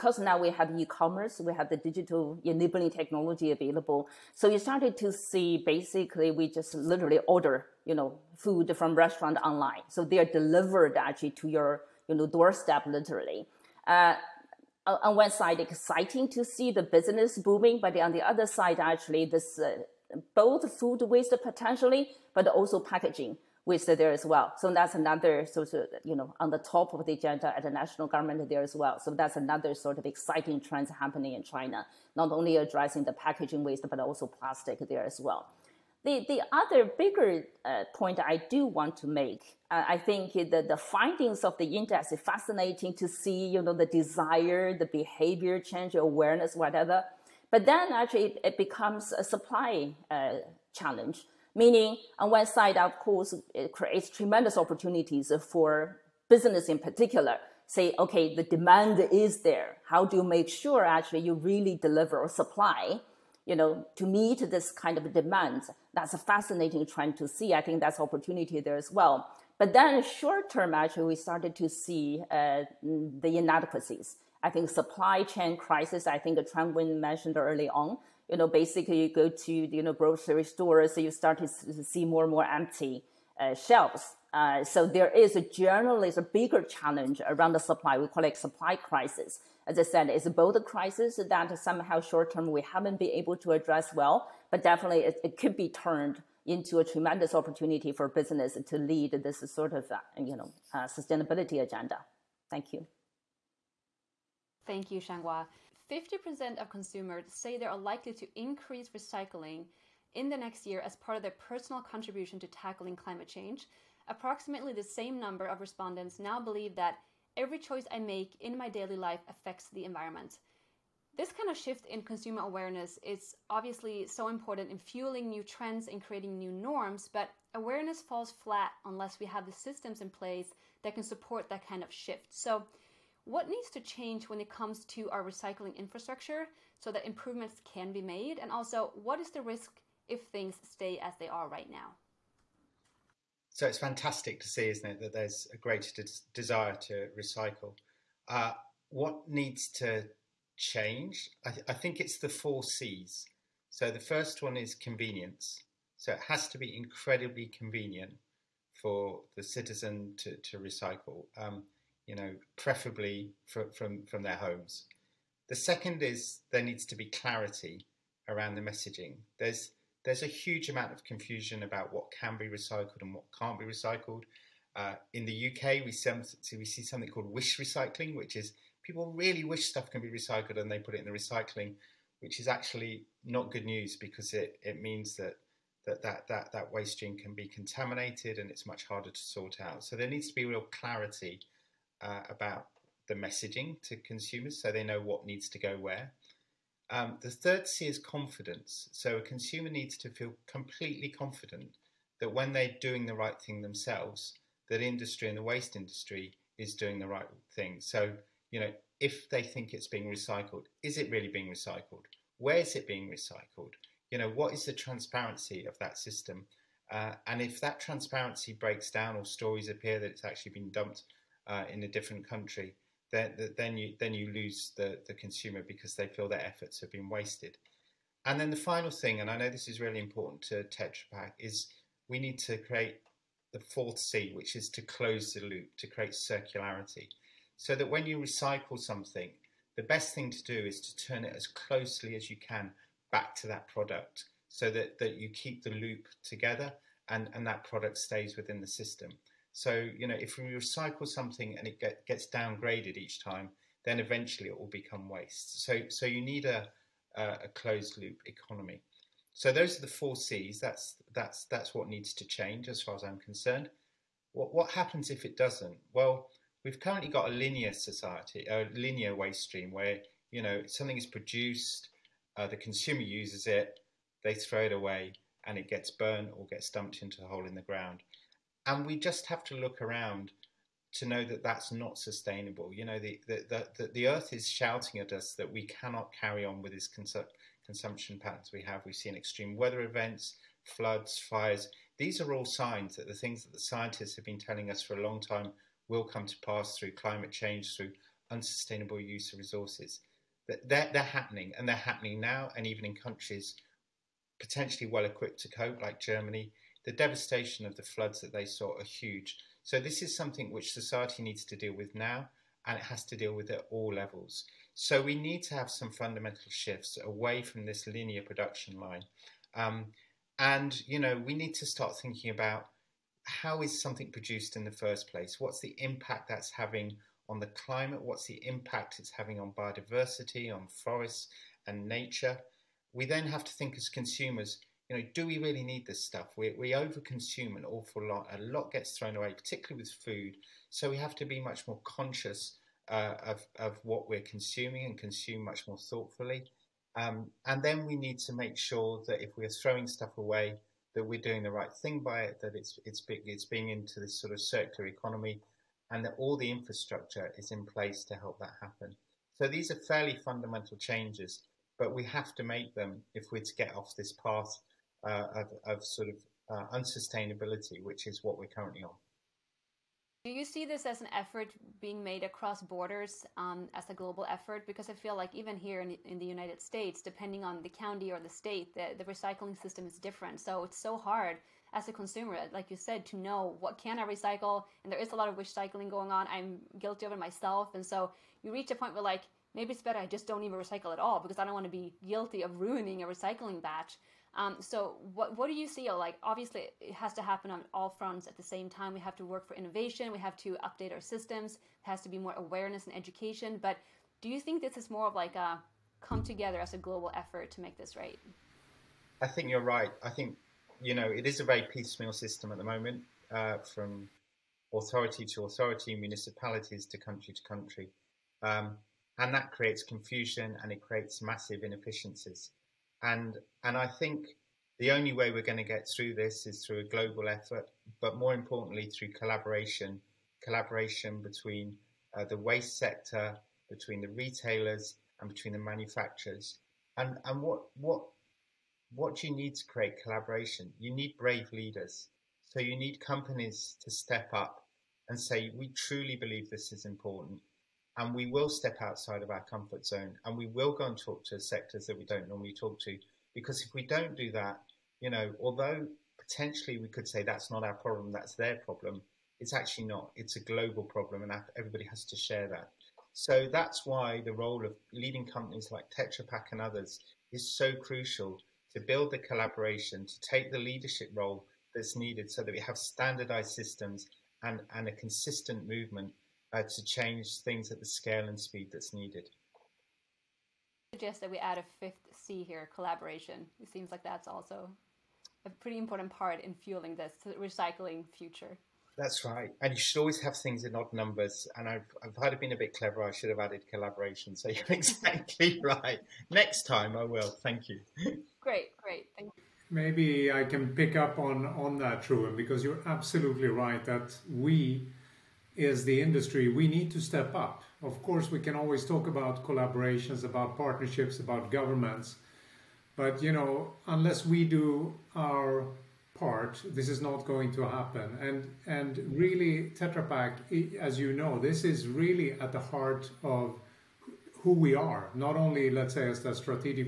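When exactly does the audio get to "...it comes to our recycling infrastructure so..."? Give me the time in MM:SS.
02:14.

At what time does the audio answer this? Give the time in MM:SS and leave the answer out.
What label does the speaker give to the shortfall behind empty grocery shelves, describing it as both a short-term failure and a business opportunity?
01:28.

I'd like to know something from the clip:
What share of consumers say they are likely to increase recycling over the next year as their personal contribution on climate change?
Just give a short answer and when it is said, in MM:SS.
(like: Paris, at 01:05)
50%, at 01:45.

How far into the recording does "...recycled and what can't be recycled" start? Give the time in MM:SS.
02:52.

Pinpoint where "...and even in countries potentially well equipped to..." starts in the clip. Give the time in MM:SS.
05:02.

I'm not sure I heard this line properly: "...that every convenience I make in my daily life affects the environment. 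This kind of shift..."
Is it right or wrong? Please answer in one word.
wrong.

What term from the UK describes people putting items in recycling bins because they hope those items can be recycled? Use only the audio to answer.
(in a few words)
wish recycling.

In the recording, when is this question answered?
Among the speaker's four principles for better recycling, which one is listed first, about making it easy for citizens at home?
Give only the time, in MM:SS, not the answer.
02:34.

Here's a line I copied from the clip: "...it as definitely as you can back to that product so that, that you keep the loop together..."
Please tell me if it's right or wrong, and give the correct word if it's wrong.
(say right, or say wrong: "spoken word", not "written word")
wrong: "closely", not "definitely".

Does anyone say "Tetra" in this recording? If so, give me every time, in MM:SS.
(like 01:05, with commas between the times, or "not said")
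03:50, 07:45, 08:39.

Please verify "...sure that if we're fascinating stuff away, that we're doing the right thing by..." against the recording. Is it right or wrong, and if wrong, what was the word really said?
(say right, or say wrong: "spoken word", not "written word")
wrong: "throwing", not "fascinating".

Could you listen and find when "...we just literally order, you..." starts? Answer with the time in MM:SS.
00:06.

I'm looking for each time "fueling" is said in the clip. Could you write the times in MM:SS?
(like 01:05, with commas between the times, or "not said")
02:04, 08:06.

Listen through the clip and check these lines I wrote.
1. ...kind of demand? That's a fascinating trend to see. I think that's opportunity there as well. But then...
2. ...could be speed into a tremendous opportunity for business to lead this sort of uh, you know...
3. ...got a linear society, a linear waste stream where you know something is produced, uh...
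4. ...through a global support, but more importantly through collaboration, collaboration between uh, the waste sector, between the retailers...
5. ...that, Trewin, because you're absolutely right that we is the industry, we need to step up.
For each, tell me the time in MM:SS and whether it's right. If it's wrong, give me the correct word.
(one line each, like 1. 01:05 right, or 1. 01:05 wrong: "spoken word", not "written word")
1. 01:04 right
2. 01:35 wrong: "turned", not "speed"
3. 04:27 right
4. 07:06 wrong: "effort", not "support"
5. 08:21 right.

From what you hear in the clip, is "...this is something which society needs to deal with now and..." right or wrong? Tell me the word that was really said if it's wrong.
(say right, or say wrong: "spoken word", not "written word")
right.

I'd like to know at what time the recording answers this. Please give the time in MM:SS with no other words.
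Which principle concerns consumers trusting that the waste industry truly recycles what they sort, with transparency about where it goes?
03:17.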